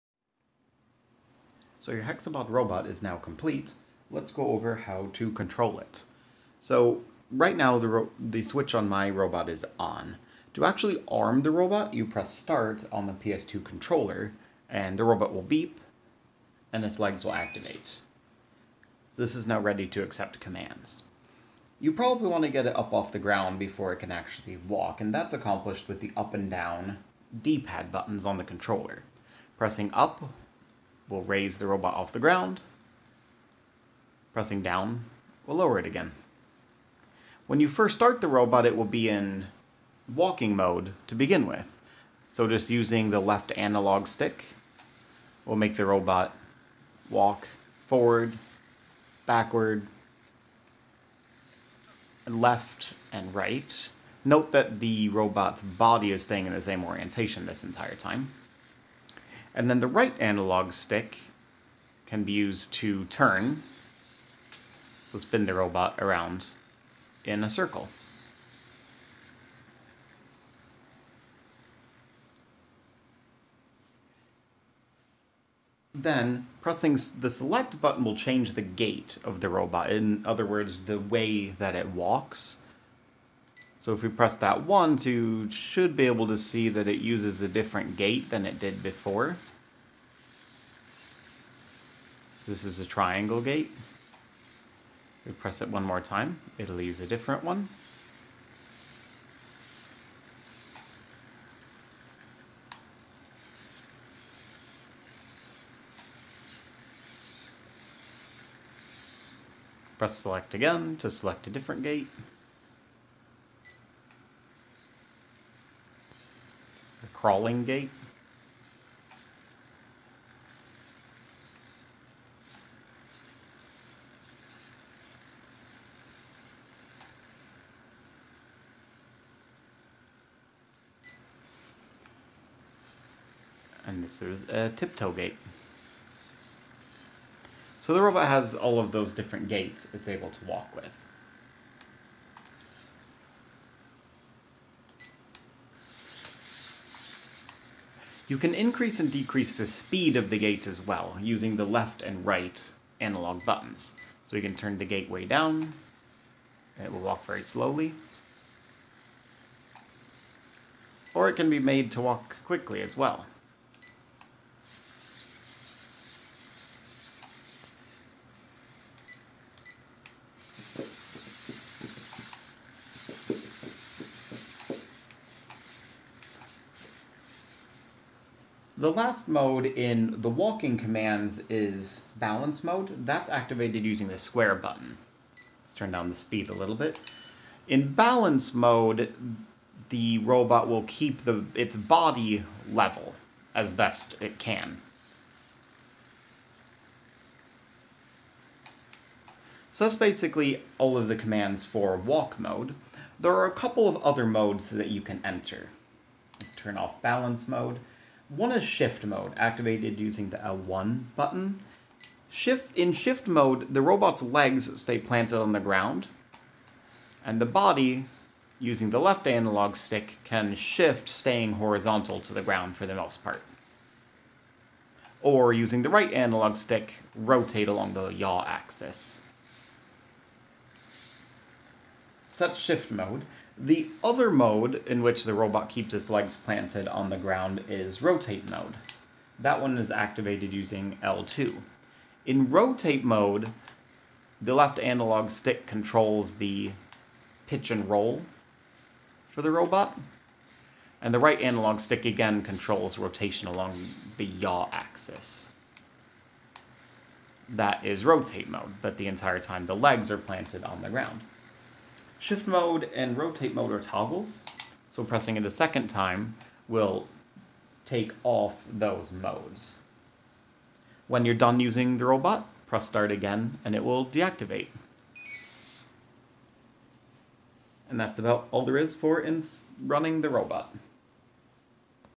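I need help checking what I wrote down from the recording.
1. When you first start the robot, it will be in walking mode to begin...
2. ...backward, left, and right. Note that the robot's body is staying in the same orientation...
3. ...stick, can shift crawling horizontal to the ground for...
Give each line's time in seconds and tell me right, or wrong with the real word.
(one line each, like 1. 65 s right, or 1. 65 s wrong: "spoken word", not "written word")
1. 37 s right
2. 49 s right
3. 219 s wrong: "staying", not "crawling".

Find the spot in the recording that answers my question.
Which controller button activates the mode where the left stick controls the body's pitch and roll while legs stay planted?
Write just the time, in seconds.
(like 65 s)
241 s.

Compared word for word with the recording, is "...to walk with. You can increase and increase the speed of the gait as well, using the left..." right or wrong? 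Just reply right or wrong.
wrong.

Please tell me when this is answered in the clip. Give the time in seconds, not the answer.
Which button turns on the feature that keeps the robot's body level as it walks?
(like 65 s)
184 s.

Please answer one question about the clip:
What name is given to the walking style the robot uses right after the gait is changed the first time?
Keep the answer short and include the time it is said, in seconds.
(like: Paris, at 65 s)
Triangle gait, at 92 s.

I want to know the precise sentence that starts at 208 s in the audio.
One is shift mode, activated using the L1 button.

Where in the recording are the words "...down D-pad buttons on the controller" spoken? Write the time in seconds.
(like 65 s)
26 s.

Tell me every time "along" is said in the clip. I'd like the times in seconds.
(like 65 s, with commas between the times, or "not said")
227 s, 253 s.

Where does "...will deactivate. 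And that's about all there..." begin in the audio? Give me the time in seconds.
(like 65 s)
273 s.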